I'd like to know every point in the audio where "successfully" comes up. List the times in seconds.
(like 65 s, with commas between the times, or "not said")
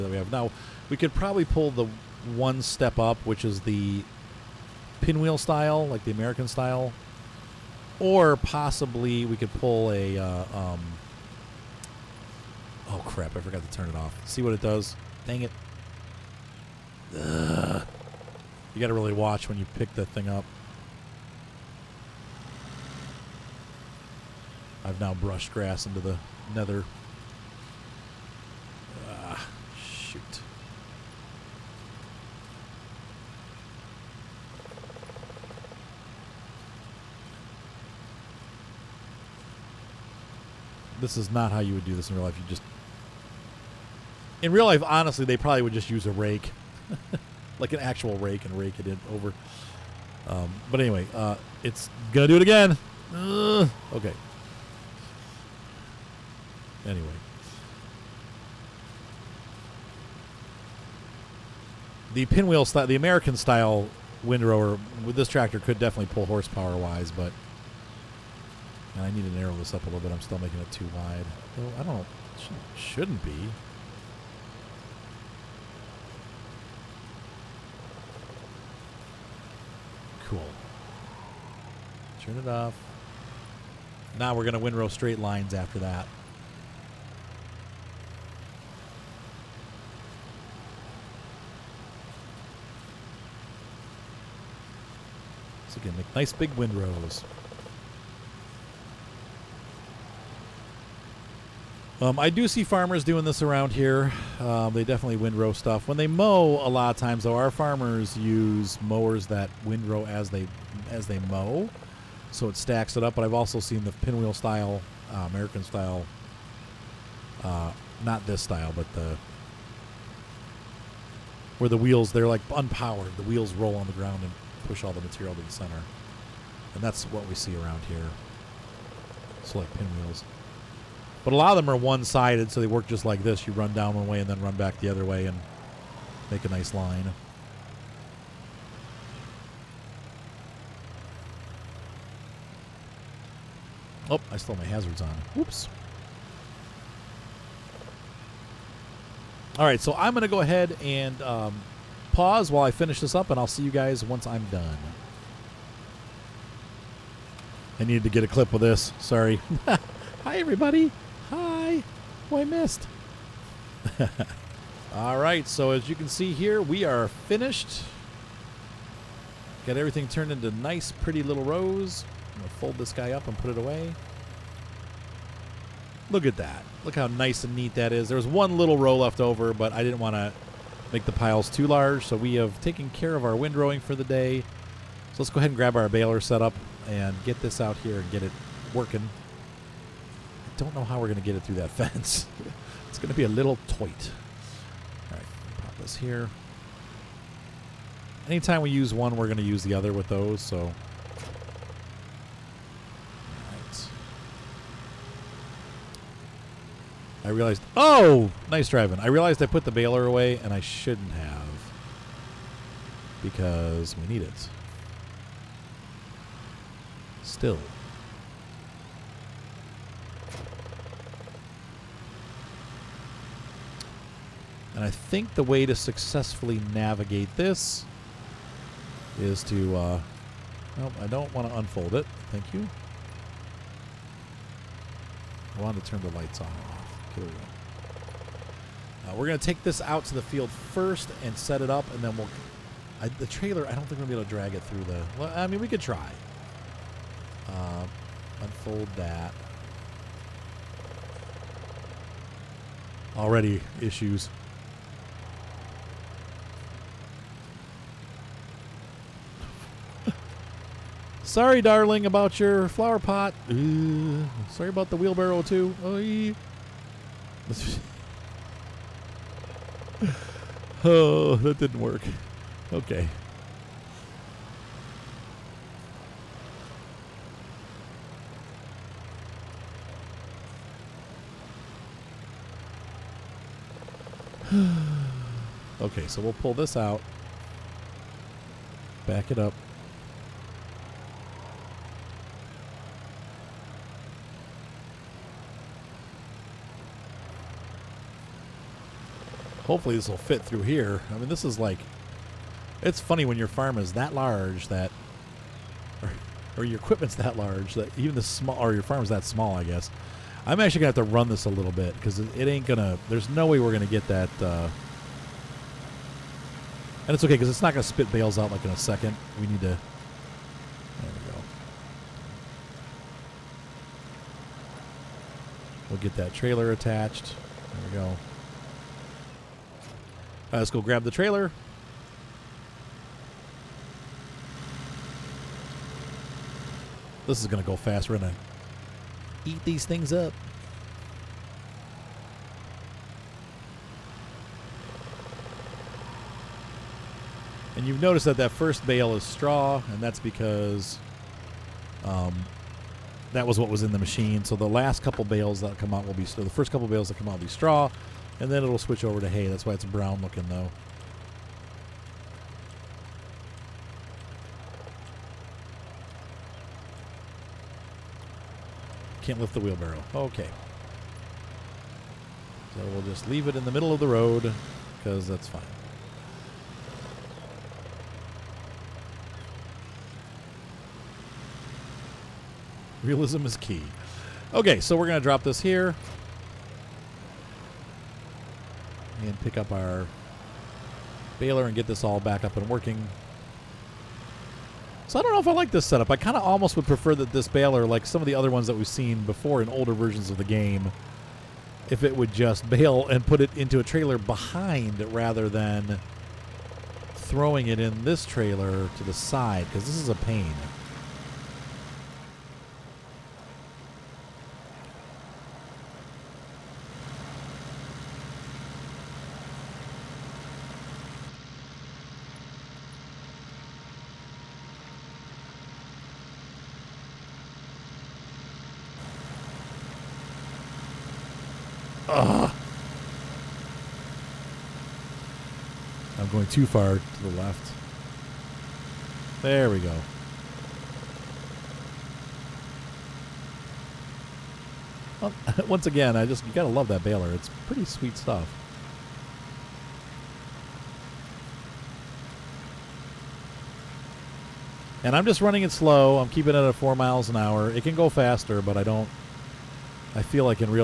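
225 s.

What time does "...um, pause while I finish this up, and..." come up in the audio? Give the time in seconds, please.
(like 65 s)
151 s.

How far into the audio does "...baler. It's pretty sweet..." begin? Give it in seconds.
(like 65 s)
447 s.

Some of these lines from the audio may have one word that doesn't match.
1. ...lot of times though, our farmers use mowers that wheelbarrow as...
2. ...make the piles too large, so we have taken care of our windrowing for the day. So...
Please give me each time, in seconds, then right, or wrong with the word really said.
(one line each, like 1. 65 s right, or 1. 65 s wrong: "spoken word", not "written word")
1. 106 s wrong: "windrow", not "wheelbarrow"
2. 180 s right.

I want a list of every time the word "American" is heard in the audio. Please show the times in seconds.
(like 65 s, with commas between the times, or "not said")
6 s, 62 s, 115 s.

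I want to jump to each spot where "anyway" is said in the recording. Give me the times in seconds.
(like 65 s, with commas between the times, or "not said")
50 s, 56 s.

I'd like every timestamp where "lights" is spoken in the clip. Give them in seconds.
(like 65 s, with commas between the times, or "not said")
236 s.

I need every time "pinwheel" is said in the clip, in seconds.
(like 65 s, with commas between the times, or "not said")
5 s, 62 s, 113 s, 129 s.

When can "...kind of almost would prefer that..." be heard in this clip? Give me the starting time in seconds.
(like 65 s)
396 s.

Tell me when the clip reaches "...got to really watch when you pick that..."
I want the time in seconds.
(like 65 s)
18 s.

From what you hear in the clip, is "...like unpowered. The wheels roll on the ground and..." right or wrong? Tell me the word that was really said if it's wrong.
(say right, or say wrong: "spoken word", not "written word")
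right.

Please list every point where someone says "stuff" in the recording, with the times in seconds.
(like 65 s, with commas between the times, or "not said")
105 s, 448 s.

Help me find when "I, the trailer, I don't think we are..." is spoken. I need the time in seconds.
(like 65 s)
243 s.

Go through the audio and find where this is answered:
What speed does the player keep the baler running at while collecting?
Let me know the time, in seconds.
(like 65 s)
456 s.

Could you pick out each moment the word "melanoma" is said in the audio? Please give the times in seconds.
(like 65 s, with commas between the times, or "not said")
not said.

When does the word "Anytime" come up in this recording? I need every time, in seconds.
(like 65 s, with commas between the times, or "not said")
198 s.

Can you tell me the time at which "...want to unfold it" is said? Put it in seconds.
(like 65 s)
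231 s.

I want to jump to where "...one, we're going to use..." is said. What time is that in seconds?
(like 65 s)
198 s.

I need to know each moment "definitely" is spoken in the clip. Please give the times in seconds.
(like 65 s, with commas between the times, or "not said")
65 s, 104 s.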